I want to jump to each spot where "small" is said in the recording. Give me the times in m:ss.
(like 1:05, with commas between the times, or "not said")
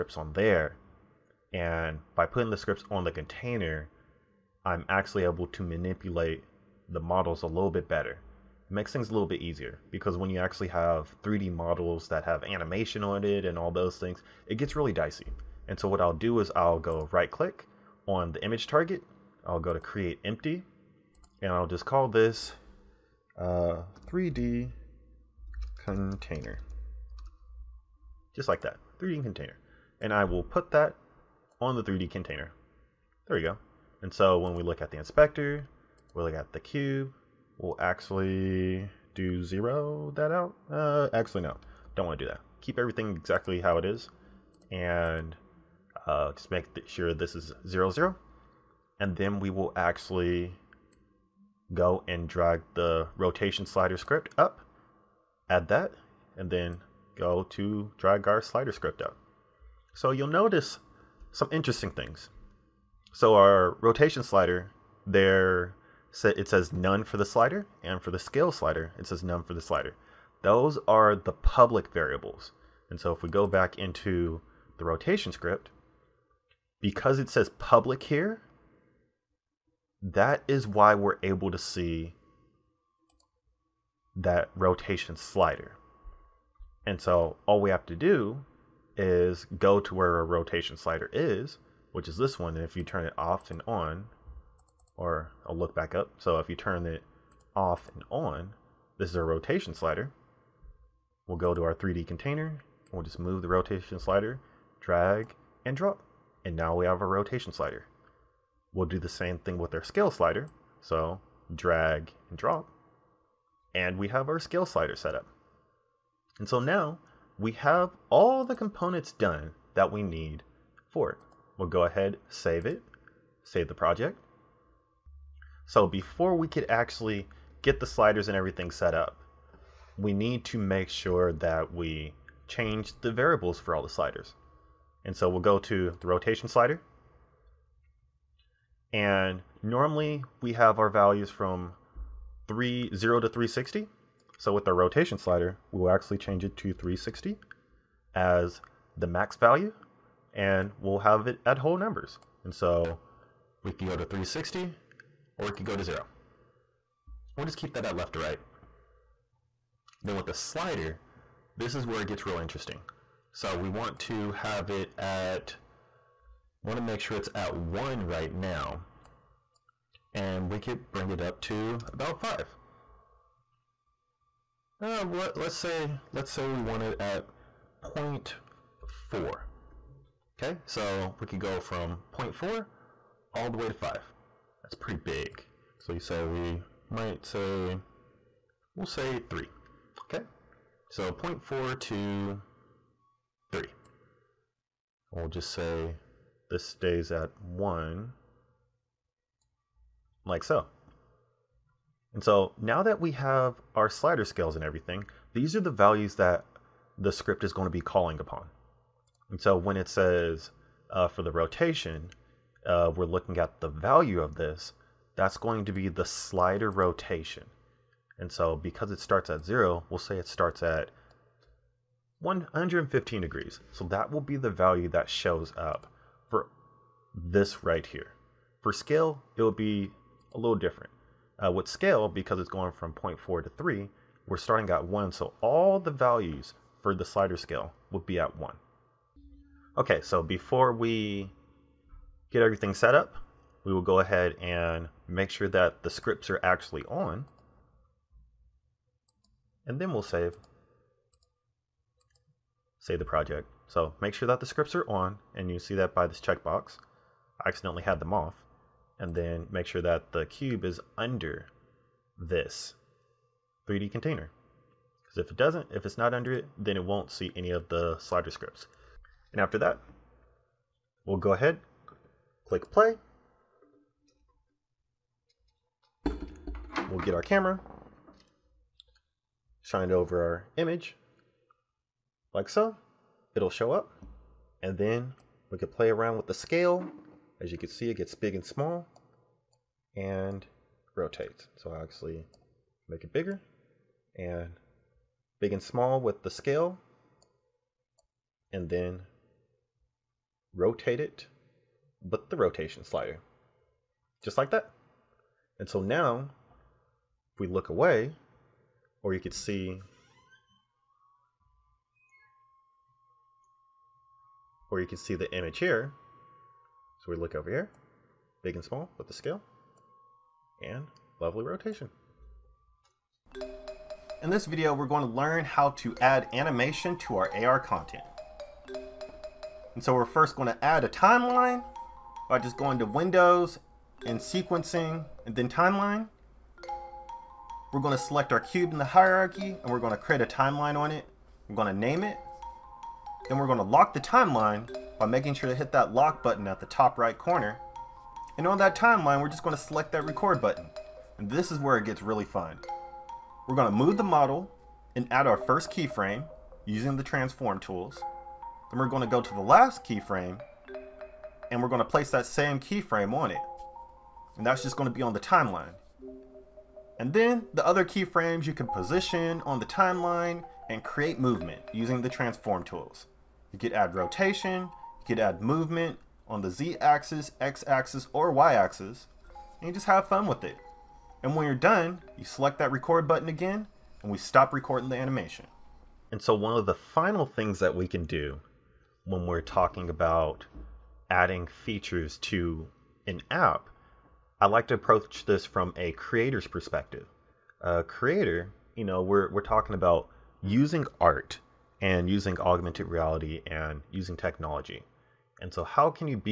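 4:48, 4:55, 5:18.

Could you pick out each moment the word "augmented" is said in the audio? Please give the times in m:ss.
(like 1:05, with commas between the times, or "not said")
6:42.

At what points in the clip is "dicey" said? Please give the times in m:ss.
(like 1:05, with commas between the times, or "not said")
0:14.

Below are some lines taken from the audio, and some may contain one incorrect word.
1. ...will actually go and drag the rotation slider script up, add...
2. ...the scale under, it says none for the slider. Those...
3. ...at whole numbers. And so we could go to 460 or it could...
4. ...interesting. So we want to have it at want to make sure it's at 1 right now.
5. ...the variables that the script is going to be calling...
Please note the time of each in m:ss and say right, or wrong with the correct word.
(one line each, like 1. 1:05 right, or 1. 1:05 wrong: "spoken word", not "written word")
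1. 0:49 right
2. 1:08 wrong: "slider", not "under"
3. 2:31 wrong: "360", not "460"
4. 2:42 right
5. 3:25 wrong: "values", not "variables".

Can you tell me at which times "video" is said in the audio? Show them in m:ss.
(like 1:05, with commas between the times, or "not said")
5:24.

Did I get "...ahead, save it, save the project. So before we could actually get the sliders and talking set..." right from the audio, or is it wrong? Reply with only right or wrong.
wrong.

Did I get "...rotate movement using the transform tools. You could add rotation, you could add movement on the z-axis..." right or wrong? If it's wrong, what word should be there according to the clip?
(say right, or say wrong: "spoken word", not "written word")
wrong: "create", not "rotate".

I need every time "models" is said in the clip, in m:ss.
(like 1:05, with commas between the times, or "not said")
0:07, 0:11, 5:54.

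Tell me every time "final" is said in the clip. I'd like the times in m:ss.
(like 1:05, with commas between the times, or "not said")
6:26.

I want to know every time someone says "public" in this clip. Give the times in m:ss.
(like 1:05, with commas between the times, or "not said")
1:11, 1:17.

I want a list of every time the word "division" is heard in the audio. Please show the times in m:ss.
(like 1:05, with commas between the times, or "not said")
not said.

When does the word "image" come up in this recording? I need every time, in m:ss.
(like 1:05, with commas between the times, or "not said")
0:18, 4:40, 5:15.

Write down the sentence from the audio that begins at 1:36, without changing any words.
So if you turn it off and on, this is our rotation slider.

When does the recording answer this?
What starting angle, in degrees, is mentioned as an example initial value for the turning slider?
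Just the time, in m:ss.
3:42.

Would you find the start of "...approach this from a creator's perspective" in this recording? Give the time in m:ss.
6:34.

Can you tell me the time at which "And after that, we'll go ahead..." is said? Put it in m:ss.
4:29.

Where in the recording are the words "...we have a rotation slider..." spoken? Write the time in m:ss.
1:46.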